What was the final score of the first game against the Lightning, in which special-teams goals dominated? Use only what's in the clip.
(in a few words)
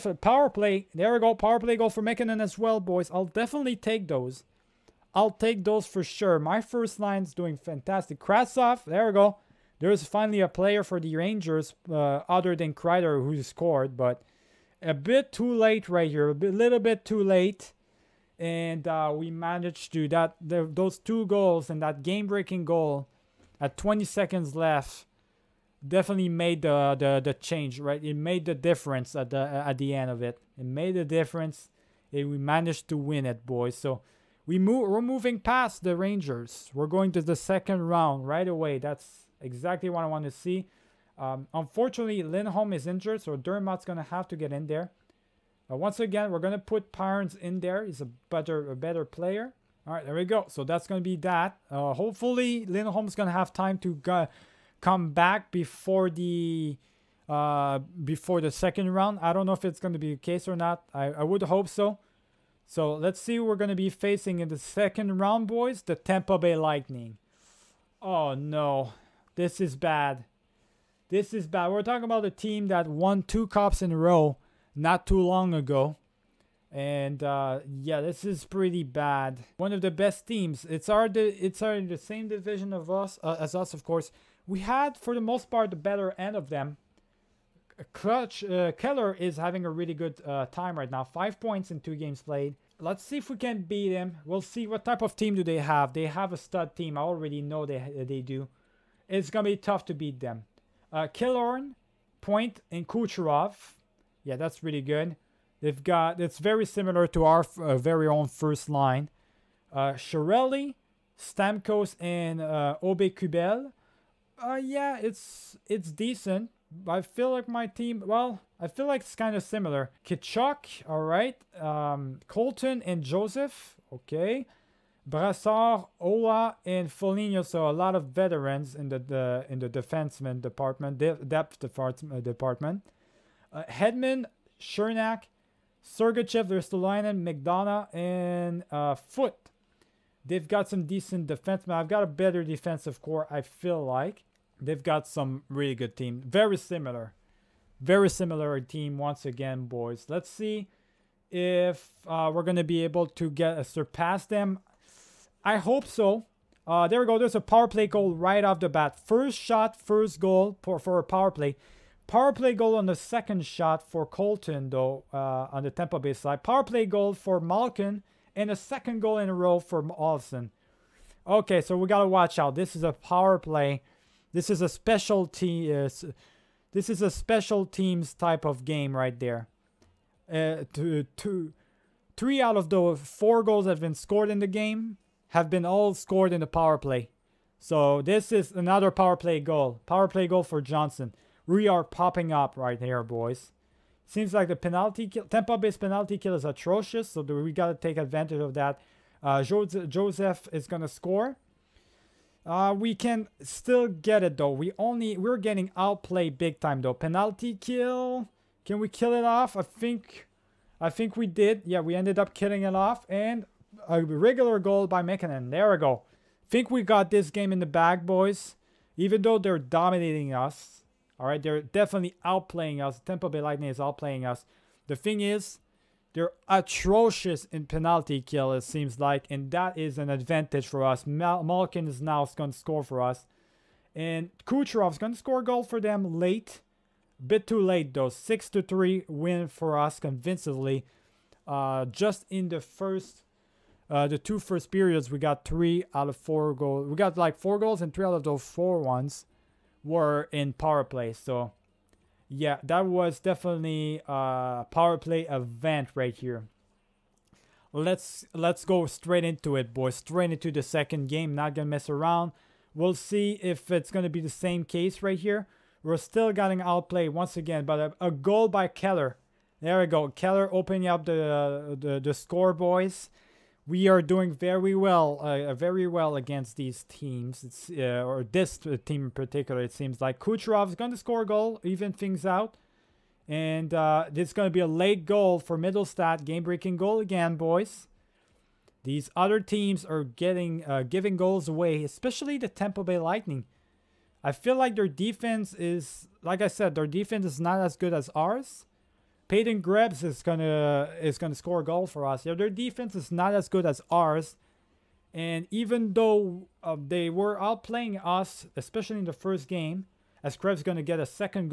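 6 to 3.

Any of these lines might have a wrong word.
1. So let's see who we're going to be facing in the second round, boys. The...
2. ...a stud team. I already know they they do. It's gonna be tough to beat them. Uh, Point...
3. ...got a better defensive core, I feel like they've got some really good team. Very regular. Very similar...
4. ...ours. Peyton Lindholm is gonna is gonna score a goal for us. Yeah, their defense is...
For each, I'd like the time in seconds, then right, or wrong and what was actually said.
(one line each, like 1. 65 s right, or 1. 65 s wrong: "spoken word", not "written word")
1. 62 s right
2. 96 s wrong: "Killorn", not "Point"
3. 141 s wrong: "similar", not "regular"
4. 298 s wrong: "Krebs", not "Lindholm".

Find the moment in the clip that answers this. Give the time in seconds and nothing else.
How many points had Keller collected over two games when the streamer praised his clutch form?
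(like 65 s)
91 s.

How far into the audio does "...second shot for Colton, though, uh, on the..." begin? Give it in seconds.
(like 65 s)
162 s.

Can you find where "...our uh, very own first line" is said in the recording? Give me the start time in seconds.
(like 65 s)
107 s.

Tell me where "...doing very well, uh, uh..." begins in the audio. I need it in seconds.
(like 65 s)
274 s.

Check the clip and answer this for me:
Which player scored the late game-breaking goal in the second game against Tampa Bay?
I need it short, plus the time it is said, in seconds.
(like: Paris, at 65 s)
Mittelstadt, at 285 s.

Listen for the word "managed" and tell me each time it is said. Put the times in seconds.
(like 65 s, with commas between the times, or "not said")
19 s, 32 s.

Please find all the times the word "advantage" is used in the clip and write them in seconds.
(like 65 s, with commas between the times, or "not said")
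197 s, 230 s.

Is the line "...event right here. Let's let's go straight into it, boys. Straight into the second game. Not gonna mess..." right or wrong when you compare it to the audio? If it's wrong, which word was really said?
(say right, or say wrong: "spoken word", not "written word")
right.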